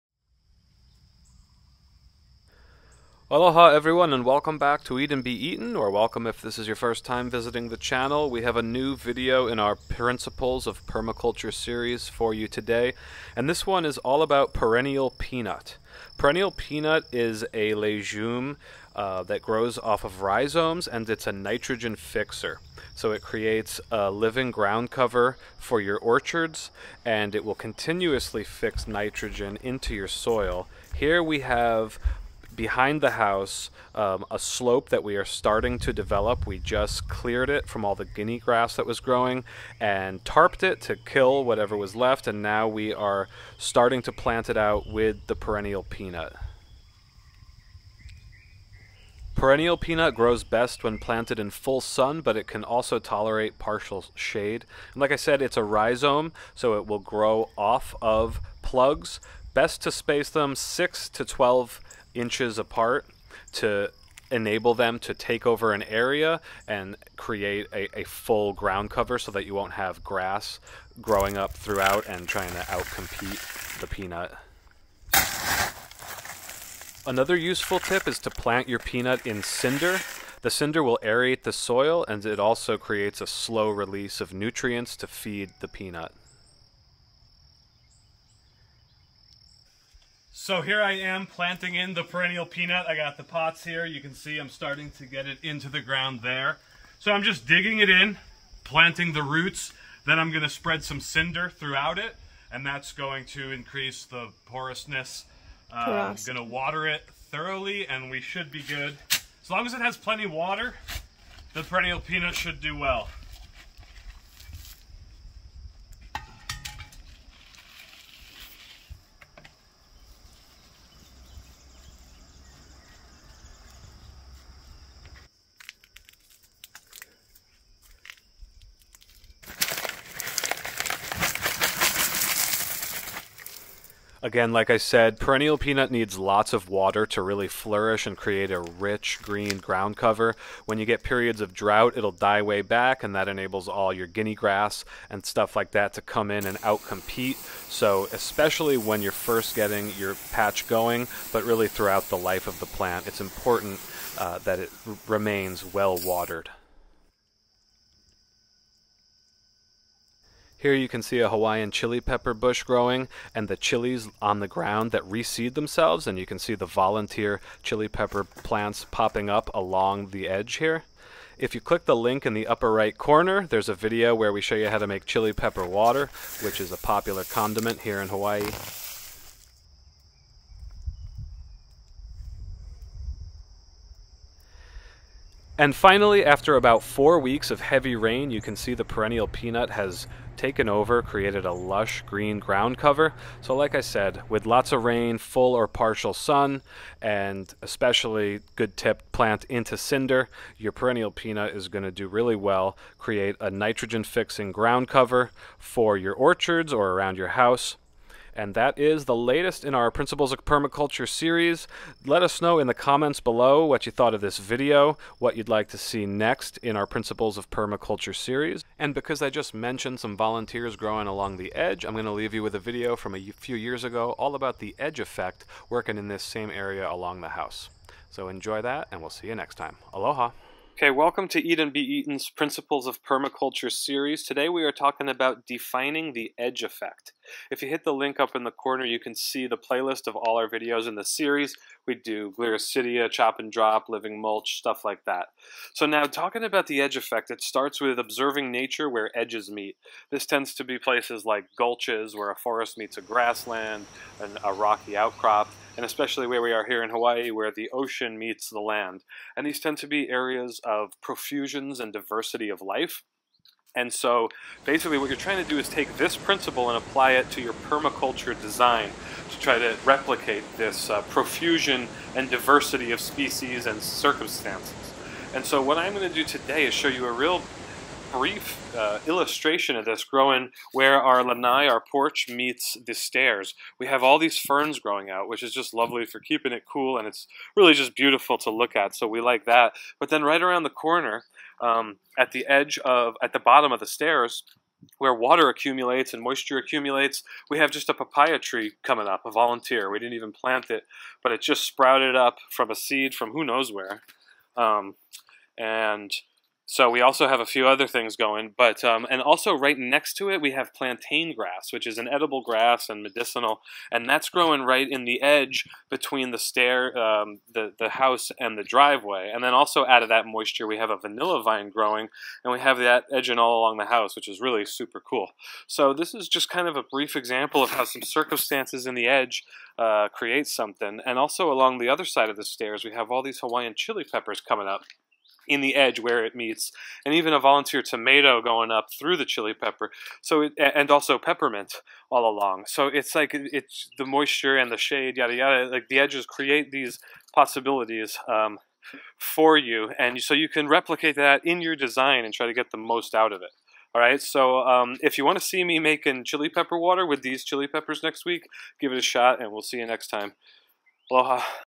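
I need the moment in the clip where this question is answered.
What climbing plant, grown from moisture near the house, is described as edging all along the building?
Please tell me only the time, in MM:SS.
05:20.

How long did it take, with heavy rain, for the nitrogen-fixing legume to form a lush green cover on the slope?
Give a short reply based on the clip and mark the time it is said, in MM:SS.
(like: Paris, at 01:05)
4 weeks, at 03:06.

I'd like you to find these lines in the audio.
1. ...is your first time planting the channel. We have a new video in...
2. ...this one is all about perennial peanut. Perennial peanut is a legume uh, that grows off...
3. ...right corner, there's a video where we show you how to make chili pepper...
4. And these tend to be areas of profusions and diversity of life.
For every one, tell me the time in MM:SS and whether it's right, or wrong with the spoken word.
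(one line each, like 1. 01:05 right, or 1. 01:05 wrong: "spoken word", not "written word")
1. 00:06 wrong: "visiting", not "planting"
2. 00:13 right
3. 02:52 right
4. 04:19 right.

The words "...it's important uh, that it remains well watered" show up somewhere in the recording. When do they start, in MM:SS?
02:33.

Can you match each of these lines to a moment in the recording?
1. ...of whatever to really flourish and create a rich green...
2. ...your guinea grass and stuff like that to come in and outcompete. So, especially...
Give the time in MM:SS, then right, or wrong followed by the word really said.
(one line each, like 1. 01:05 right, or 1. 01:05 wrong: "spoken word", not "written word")
1. 02:16 wrong: "water", not "whatever"
2. 02:23 right.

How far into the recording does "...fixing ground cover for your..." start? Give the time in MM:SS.
03:24.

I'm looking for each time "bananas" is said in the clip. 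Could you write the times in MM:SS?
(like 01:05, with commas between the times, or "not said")
not said.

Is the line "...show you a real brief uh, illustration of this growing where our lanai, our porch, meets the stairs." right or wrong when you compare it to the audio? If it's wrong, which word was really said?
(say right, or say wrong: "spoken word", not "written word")
right.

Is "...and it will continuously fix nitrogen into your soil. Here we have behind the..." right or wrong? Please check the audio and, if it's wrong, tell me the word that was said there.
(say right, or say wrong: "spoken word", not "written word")
right.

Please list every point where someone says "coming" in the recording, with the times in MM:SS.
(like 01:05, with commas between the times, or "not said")
04:58, 05:34.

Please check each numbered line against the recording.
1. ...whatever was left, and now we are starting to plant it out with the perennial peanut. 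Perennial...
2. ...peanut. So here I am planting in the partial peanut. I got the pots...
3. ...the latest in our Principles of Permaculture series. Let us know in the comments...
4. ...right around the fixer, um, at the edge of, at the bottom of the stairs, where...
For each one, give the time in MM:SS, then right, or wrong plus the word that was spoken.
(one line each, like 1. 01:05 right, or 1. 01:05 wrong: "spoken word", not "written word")
1. 00:41 right
2. 01:25 wrong: "perennial", not "partial"
3. 03:29 right
4. 04:50 wrong: "corner", not "fixer".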